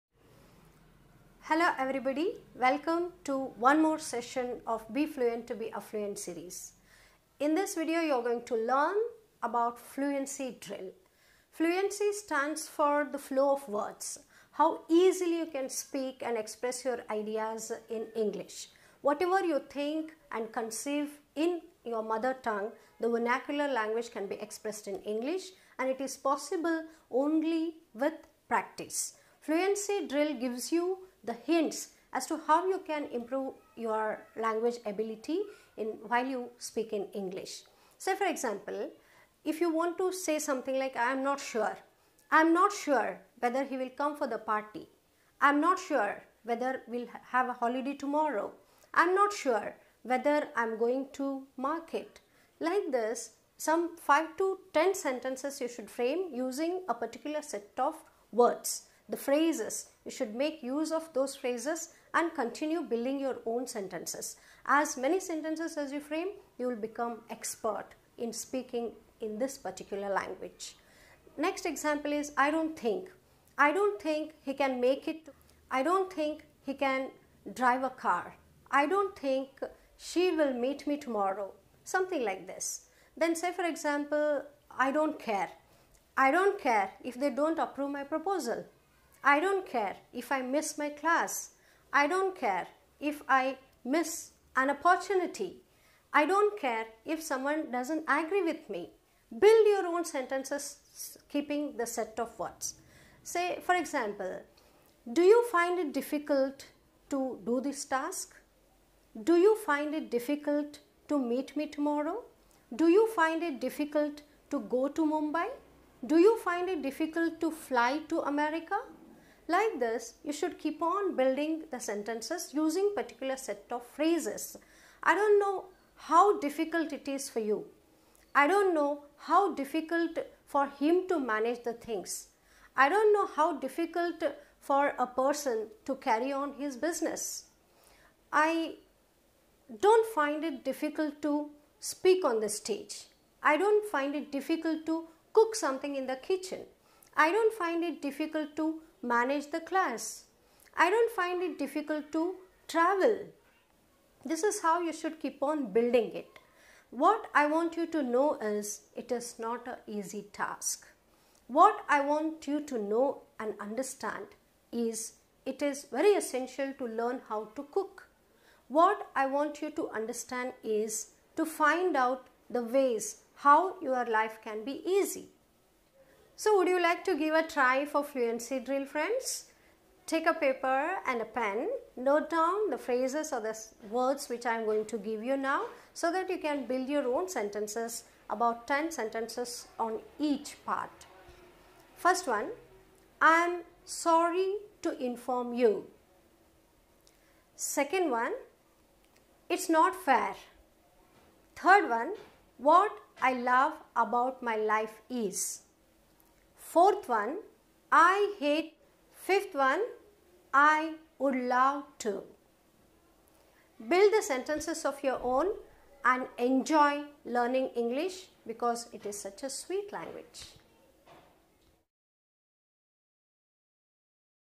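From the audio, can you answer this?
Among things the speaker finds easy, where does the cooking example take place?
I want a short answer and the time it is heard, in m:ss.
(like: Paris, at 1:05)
in the kitchen, at 2:25.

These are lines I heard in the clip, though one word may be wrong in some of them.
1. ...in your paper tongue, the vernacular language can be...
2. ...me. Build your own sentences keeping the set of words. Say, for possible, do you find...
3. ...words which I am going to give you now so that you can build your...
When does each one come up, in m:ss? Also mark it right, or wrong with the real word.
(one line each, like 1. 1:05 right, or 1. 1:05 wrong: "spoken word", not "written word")
1. 0:21 wrong: "mother", not "paper"
2. 1:38 wrong: "example", not "possible"
3. 3:03 right.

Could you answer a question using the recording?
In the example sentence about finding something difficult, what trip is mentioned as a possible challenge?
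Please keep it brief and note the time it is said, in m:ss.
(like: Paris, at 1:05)
fly to America, at 1:57.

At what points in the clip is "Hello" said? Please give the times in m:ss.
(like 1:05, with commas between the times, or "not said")
0:01.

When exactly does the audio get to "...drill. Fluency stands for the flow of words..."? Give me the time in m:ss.
0:10.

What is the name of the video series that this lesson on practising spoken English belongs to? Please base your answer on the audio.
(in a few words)
Be Fluent to Be Affluent.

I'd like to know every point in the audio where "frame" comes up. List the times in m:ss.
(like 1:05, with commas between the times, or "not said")
0:55, 1:05.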